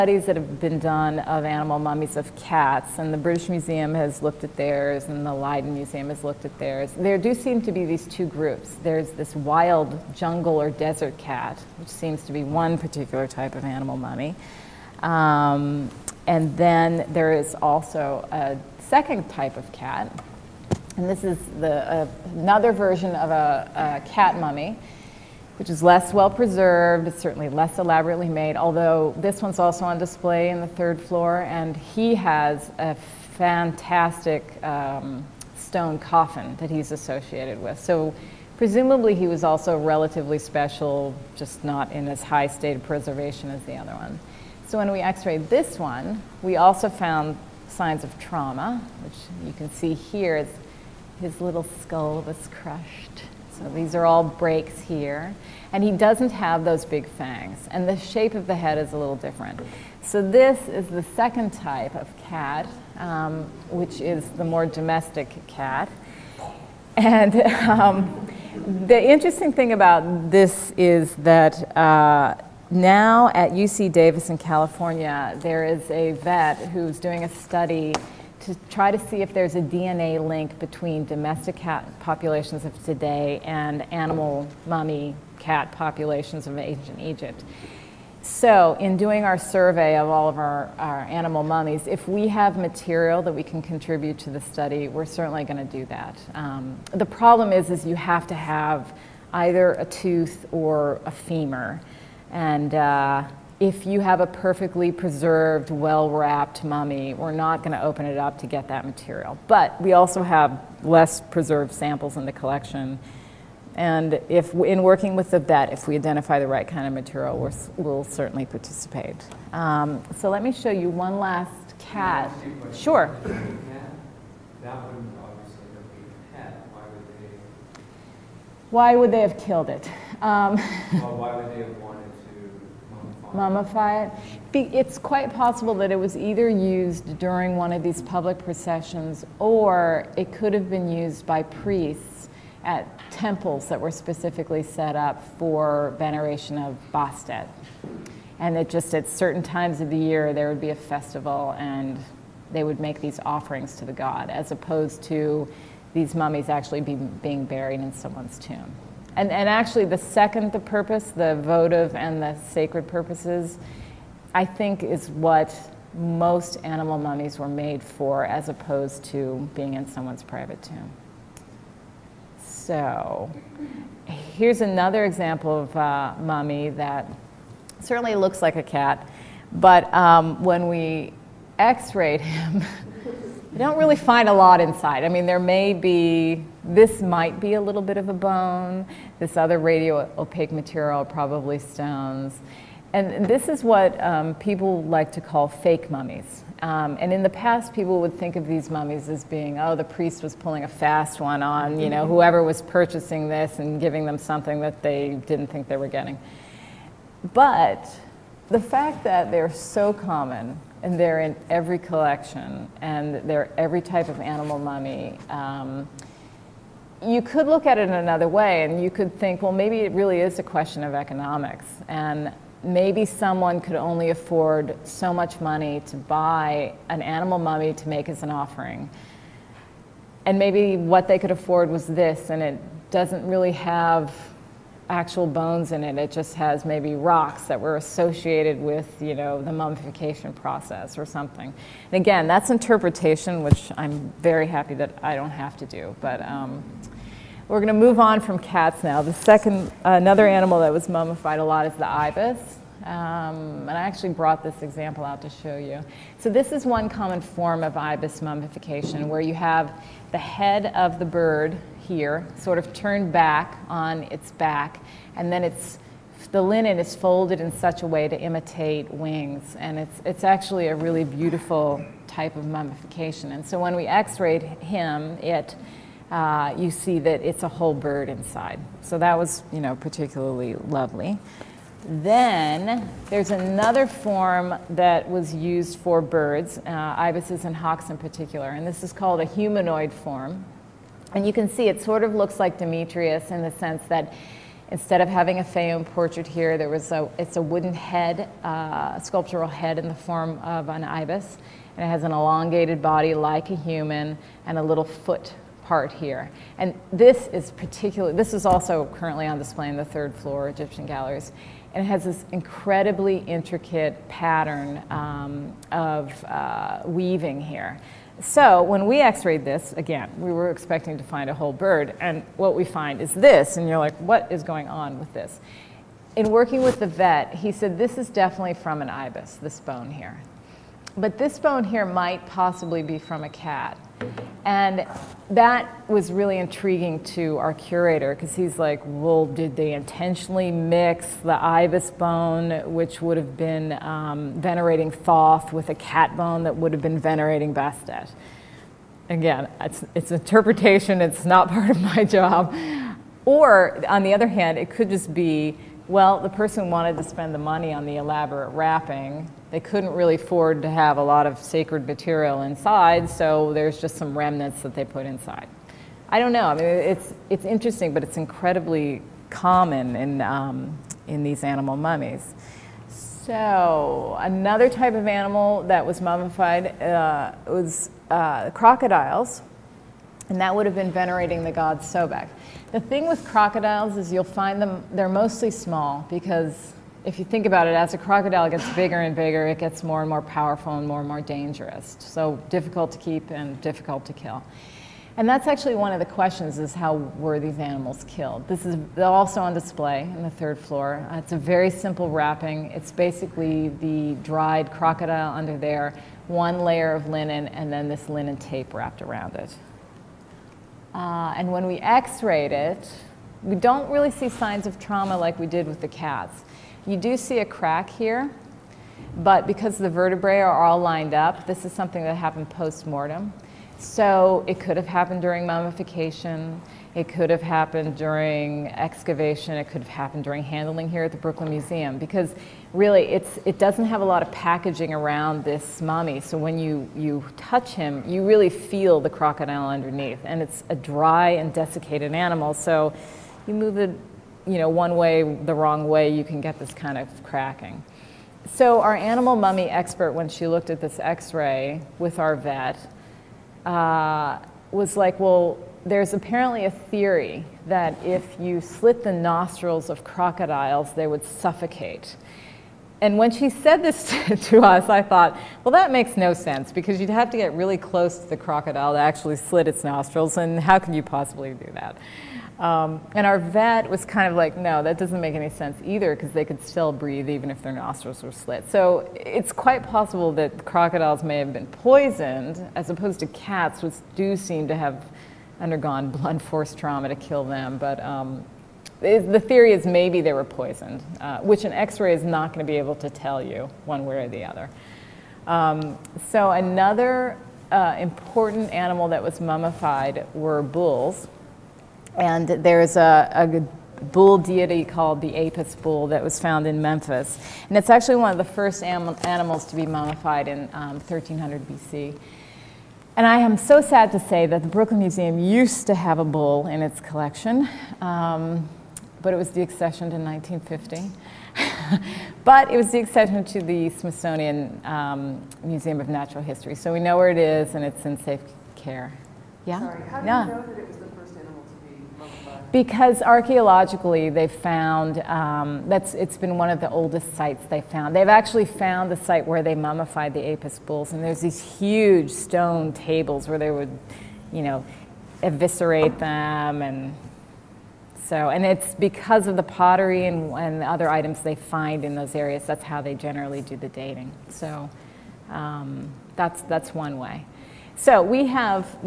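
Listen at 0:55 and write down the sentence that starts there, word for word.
And he doesn't have those big fangs.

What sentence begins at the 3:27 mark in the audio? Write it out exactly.
But the fact that they're so common and they're in every collection and they're every type of animal mummy.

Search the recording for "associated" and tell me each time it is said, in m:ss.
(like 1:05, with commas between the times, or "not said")
0:36, 3:57.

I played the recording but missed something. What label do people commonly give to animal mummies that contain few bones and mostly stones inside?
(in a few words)
Fake mummies.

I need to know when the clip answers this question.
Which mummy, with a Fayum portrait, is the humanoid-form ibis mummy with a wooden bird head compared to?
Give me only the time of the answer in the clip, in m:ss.
4:52.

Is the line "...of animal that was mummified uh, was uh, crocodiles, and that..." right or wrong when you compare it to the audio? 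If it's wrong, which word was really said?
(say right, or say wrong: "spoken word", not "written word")
right.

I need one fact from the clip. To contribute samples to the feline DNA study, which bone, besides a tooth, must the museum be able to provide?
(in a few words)
Femur.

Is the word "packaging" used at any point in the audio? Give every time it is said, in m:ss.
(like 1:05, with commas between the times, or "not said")
7:14.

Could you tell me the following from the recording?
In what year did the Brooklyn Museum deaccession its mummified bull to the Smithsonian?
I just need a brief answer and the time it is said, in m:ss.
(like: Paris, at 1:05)
1950, at 8:40.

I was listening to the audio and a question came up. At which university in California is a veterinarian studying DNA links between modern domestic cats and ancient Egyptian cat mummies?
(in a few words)
UC Davis.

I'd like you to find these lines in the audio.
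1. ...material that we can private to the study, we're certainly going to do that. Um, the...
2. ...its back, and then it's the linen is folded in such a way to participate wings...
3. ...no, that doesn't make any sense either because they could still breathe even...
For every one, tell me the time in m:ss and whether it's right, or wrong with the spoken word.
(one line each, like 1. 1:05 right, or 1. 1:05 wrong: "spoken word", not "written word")
1. 1:32 wrong: "contribute", not "private"
2. 4:24 wrong: "imitate", not "participate"
3. 7:54 right.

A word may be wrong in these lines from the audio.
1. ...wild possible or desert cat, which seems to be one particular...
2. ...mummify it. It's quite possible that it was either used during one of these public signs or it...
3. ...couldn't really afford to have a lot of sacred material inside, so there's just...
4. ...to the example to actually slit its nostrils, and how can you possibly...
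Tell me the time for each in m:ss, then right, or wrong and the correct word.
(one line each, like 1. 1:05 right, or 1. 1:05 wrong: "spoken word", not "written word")
1. 0:09 wrong: "jungle", not "possible"
2. 2:13 wrong: "processions", not "signs"
3. 5:59 right
4. 7:48 wrong: "crocodile", not "example".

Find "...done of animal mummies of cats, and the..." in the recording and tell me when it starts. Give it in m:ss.
0:00.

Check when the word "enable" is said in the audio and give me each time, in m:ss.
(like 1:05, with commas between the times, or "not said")
not said.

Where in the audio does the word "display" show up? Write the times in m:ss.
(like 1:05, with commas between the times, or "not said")
0:29, 5:09, 6:39.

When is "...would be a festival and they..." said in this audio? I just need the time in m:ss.
2:30.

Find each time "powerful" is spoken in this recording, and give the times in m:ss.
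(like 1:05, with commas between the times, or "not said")
6:30.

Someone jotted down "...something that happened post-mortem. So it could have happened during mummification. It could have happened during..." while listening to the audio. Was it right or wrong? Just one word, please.
right.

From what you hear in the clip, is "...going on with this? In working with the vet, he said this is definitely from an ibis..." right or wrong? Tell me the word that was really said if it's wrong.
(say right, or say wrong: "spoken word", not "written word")
right.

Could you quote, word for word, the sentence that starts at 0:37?
So presumably he was also relatively special, just not in as high state of preservation as the other one.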